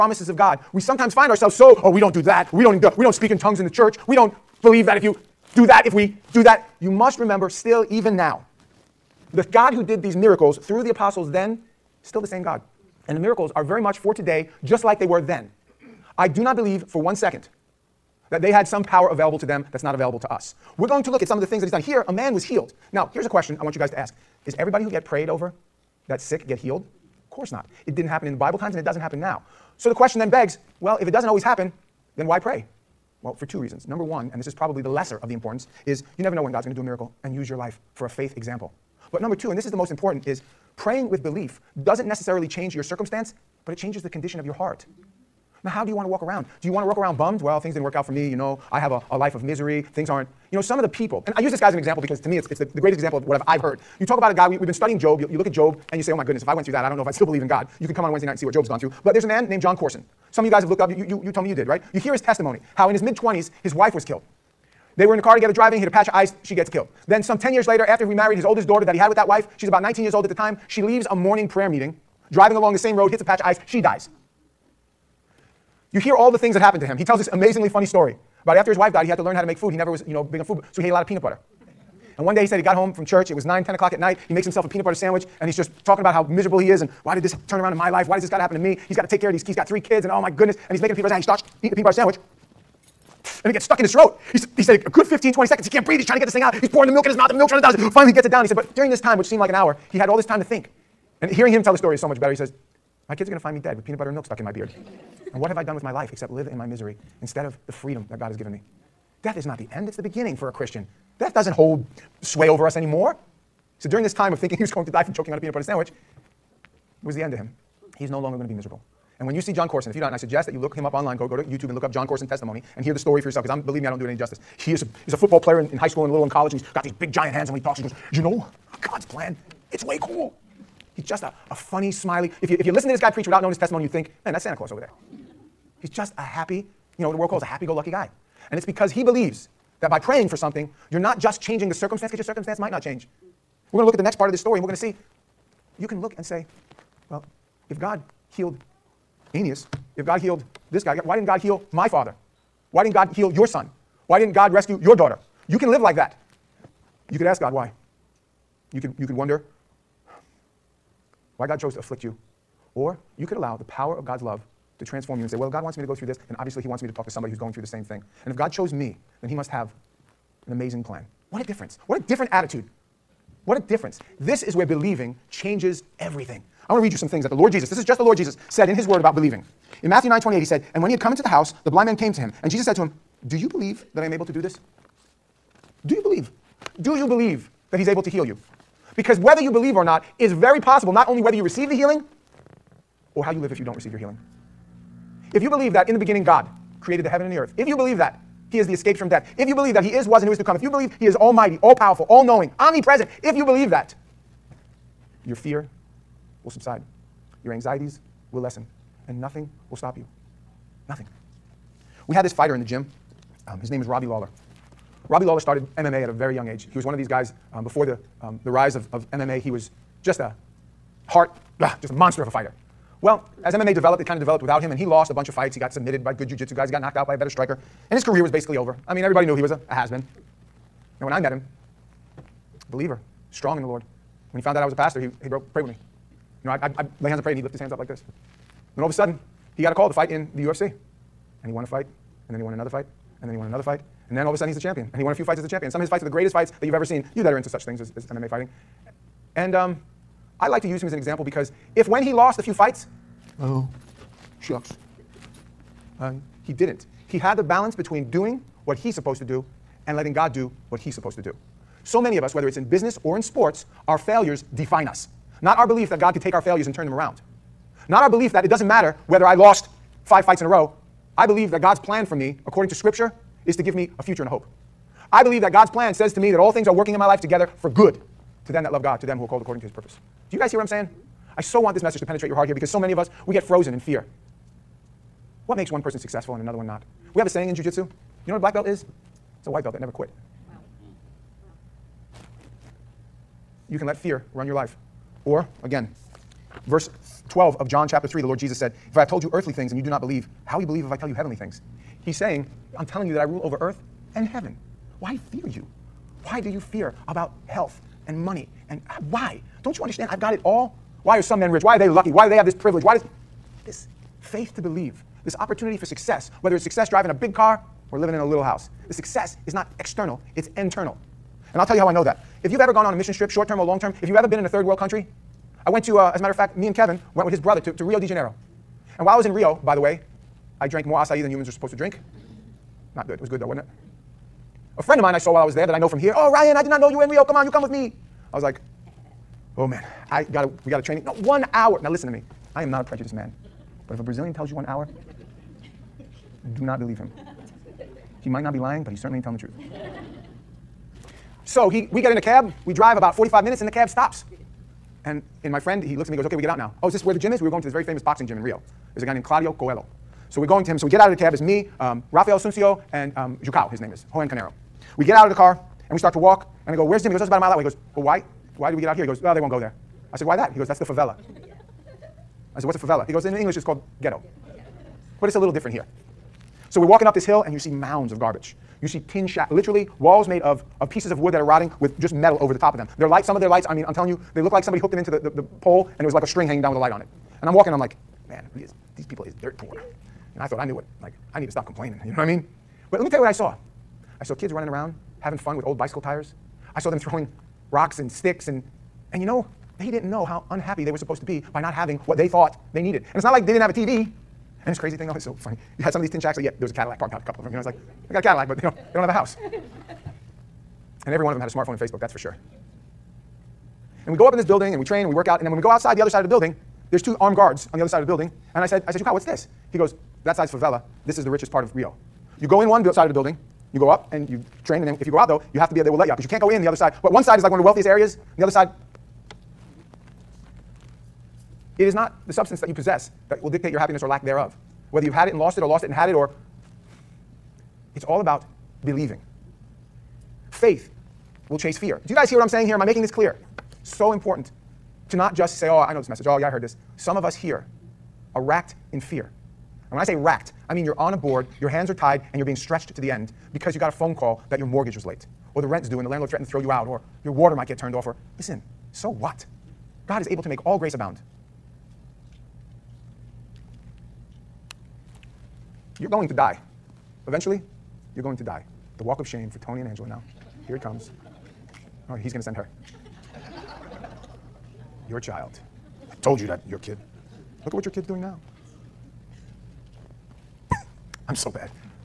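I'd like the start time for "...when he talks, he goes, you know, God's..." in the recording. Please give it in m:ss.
2:07.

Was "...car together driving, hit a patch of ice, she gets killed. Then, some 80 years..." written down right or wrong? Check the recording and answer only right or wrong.
wrong.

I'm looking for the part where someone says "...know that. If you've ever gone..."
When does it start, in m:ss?
5:21.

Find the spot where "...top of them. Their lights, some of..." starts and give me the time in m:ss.
6:22.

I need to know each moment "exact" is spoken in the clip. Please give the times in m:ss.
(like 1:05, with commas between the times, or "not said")
not said.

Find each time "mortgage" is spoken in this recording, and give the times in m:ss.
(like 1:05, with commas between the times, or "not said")
7:34.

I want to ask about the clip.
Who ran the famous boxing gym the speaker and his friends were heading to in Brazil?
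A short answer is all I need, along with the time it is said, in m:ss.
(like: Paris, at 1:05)
Claudio Coelho, at 5:59.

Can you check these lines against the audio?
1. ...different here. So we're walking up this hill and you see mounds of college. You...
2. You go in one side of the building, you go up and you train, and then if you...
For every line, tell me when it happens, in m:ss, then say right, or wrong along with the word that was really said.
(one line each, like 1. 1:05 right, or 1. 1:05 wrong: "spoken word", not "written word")
1. 6:15 wrong: "garbage", not "college"
2. 7:02 right.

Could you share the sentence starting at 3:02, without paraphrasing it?
And Jesus said to him, Do you believe that I am able to do this?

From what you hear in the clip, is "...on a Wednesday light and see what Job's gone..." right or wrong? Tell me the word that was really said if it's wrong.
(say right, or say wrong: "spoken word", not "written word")
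wrong: "night", not "light".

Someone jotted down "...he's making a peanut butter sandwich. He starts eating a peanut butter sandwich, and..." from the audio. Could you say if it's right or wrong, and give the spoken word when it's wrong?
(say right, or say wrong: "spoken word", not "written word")
right.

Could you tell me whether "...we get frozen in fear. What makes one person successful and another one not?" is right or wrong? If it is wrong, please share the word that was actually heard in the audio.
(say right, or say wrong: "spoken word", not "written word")
right.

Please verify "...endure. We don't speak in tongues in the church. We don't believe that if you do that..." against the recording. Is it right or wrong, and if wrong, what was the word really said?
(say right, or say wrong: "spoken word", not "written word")
right.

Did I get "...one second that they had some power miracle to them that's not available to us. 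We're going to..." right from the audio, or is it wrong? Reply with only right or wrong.
wrong.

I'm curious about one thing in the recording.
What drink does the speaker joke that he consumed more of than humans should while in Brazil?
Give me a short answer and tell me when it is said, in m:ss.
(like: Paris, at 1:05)
Acai, at 5:30.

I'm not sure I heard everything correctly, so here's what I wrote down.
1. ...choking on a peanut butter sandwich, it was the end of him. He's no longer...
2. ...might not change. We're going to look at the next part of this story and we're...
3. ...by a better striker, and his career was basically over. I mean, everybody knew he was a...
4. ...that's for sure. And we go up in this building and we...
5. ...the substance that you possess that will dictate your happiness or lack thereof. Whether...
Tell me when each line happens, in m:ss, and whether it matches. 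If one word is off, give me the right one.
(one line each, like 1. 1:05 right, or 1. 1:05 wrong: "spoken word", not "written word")
1. 1:55 right
2. 2:22 right
3. 3:47 right
4. 6:51 right
5. 7:12 right.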